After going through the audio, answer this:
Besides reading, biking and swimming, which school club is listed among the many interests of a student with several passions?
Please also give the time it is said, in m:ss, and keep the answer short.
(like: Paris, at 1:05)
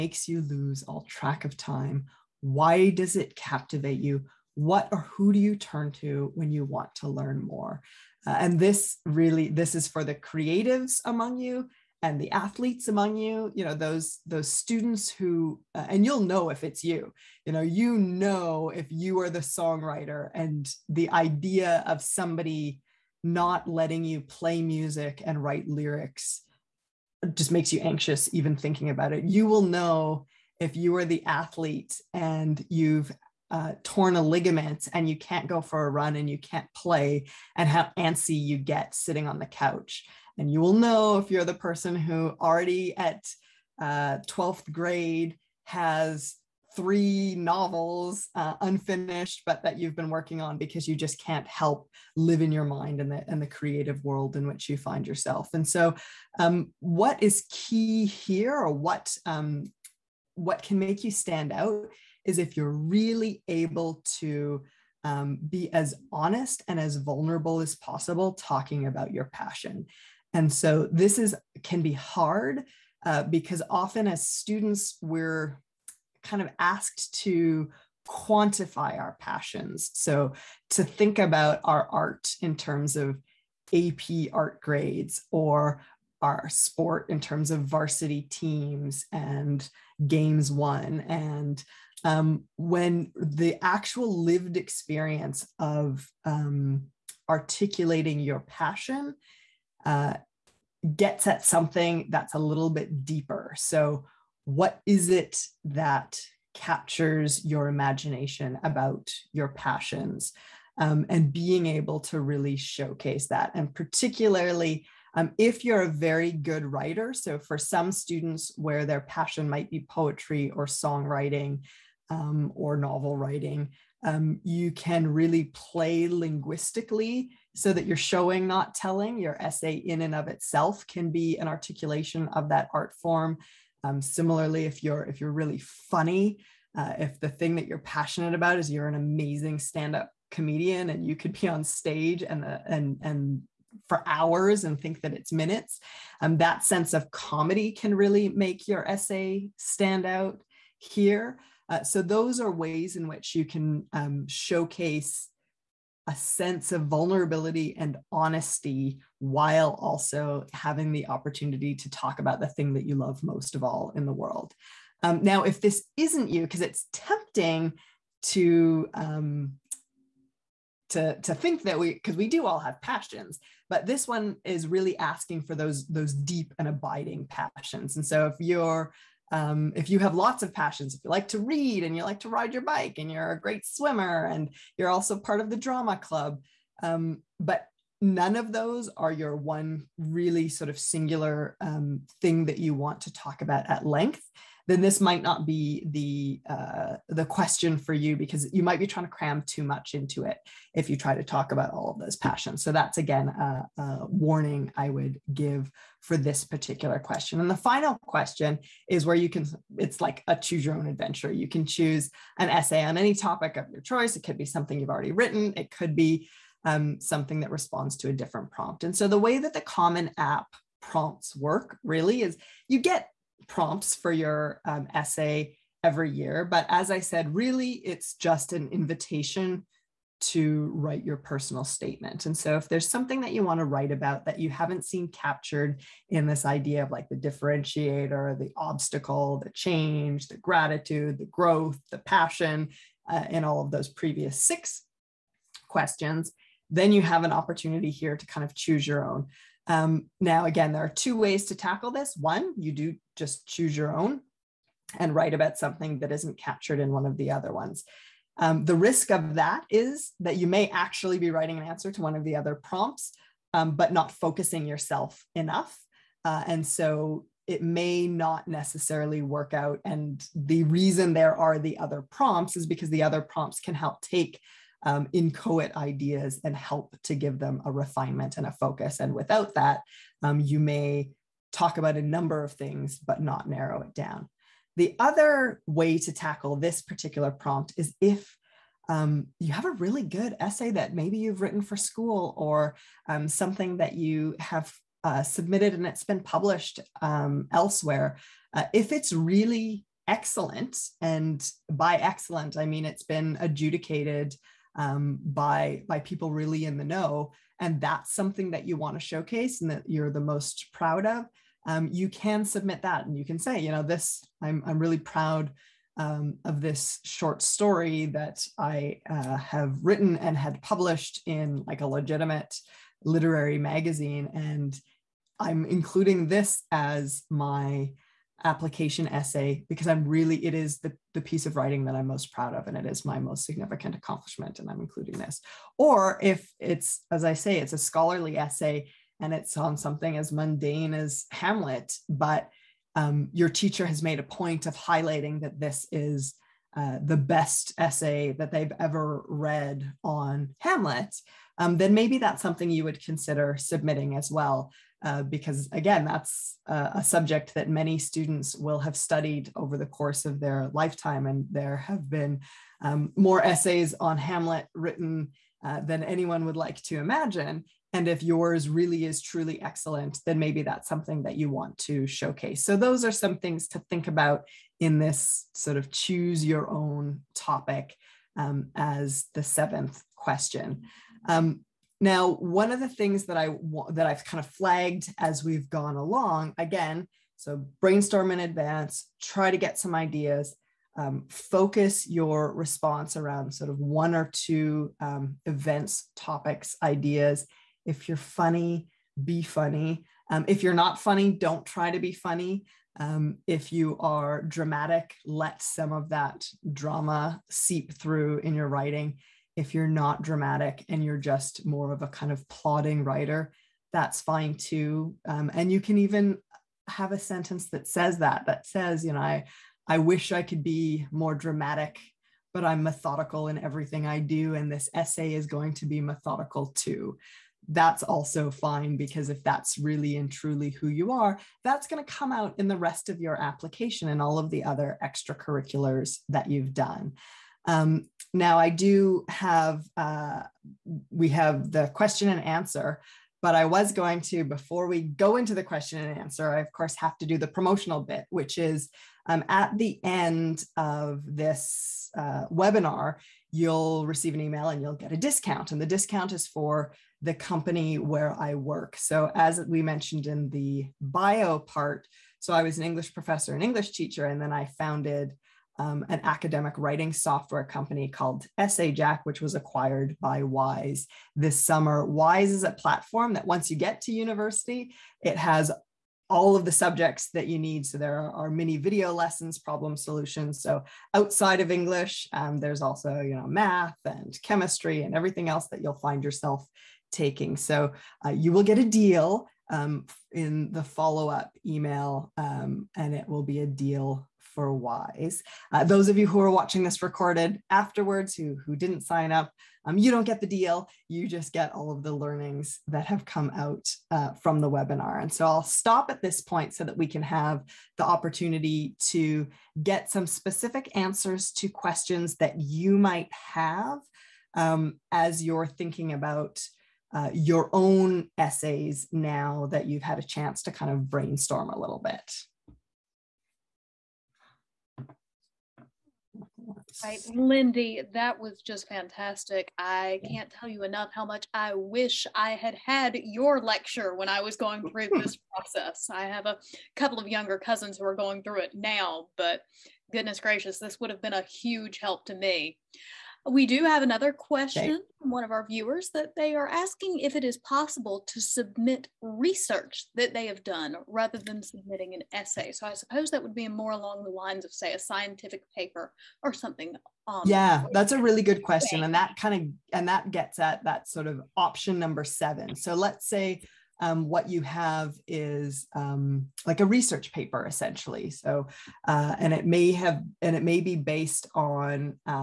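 drama club, at 3:05.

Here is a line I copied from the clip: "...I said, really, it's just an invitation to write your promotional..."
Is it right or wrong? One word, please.
wrong.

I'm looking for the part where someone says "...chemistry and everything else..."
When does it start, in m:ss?
8:04.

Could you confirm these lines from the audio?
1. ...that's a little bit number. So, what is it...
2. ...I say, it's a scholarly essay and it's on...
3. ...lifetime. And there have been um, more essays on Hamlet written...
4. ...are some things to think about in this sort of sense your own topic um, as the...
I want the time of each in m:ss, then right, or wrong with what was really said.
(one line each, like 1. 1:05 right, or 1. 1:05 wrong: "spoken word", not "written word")
1. 1:42 wrong: "deeper", not "number"
2. 5:37 right
3. 6:00 right
4. 6:13 wrong: "choose", not "sense".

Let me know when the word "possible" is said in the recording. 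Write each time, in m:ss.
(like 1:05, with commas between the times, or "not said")
1:07, 9:07.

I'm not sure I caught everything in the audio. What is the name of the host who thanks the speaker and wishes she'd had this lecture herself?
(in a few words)
Lindy.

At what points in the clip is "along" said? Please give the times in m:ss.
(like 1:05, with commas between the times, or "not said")
6:25, 9:13.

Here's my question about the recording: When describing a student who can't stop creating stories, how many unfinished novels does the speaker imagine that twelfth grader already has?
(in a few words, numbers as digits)
3.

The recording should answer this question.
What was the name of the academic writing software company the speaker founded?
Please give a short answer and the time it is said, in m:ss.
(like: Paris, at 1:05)
Jack, at 7:48.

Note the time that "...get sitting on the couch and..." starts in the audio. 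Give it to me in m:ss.
0:38.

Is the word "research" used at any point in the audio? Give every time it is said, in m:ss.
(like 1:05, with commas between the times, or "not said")
9:09, 9:26.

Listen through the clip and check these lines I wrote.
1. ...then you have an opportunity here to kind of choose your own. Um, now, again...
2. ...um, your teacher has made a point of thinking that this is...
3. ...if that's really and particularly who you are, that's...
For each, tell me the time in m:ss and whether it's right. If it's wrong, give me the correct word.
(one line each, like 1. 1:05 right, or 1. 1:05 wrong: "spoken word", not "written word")
1. 4:06 right
2. 5:42 wrong: "highlighting", not "thinking"
3. 7:09 wrong: "truly", not "particularly".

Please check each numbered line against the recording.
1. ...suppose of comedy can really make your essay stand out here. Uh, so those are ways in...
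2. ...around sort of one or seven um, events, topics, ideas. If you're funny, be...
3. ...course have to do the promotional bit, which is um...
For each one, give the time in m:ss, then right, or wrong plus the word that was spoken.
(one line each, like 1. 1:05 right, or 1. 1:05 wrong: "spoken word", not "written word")
1. 2:26 wrong: "sense", not "suppose"
2. 6:33 wrong: "two", not "seven"
3. 7:26 right.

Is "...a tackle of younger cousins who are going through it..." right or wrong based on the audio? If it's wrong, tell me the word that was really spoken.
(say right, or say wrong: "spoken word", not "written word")
wrong: "couple", not "tackle".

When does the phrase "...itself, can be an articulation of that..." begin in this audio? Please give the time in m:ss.
2:10.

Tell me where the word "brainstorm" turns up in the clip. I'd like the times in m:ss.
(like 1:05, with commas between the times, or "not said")
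6:27, 8:41.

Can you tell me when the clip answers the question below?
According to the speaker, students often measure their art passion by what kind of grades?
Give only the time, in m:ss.
1:23.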